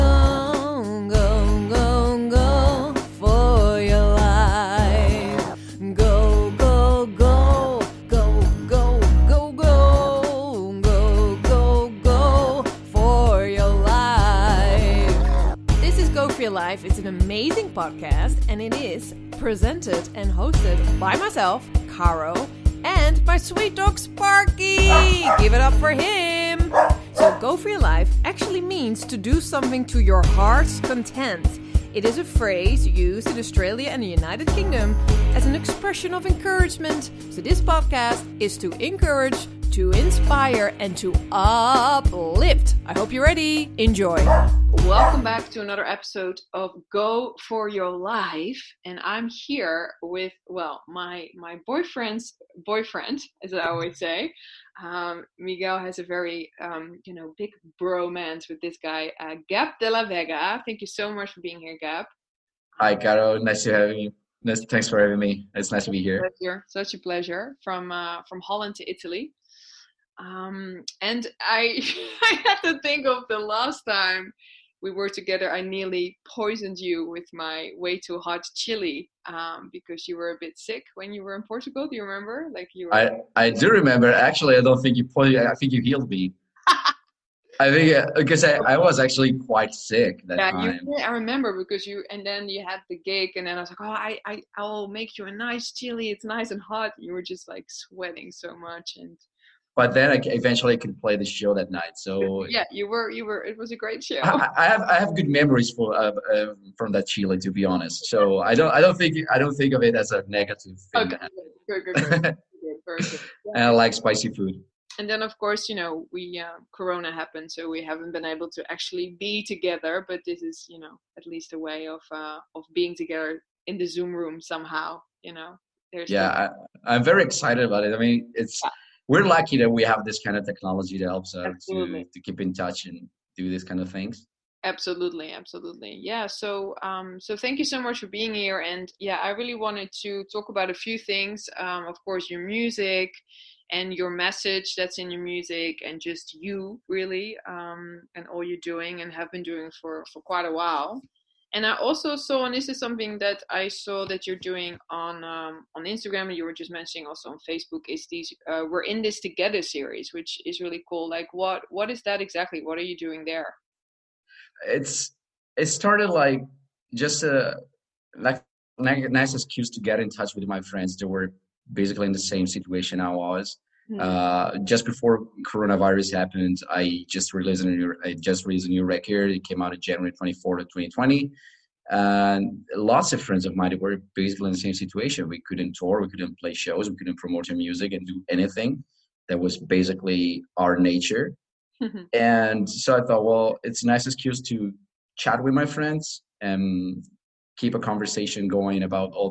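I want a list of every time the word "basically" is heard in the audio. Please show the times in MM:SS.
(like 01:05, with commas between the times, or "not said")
02:51, 03:04, 03:09.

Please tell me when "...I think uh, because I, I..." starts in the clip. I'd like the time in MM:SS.
01:27.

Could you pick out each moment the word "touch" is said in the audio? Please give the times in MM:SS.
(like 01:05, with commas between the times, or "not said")
02:12, 02:50.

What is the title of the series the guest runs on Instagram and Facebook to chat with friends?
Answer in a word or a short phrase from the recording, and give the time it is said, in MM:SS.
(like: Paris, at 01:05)
We're in this together, at 02:38.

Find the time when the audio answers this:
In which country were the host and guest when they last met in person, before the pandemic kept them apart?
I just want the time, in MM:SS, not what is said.
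01:21.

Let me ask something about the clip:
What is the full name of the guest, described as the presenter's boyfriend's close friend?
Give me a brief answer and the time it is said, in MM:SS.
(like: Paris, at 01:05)
Gab de la Vega, at 00:59.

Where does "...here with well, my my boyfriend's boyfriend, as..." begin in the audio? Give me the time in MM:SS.
00:49.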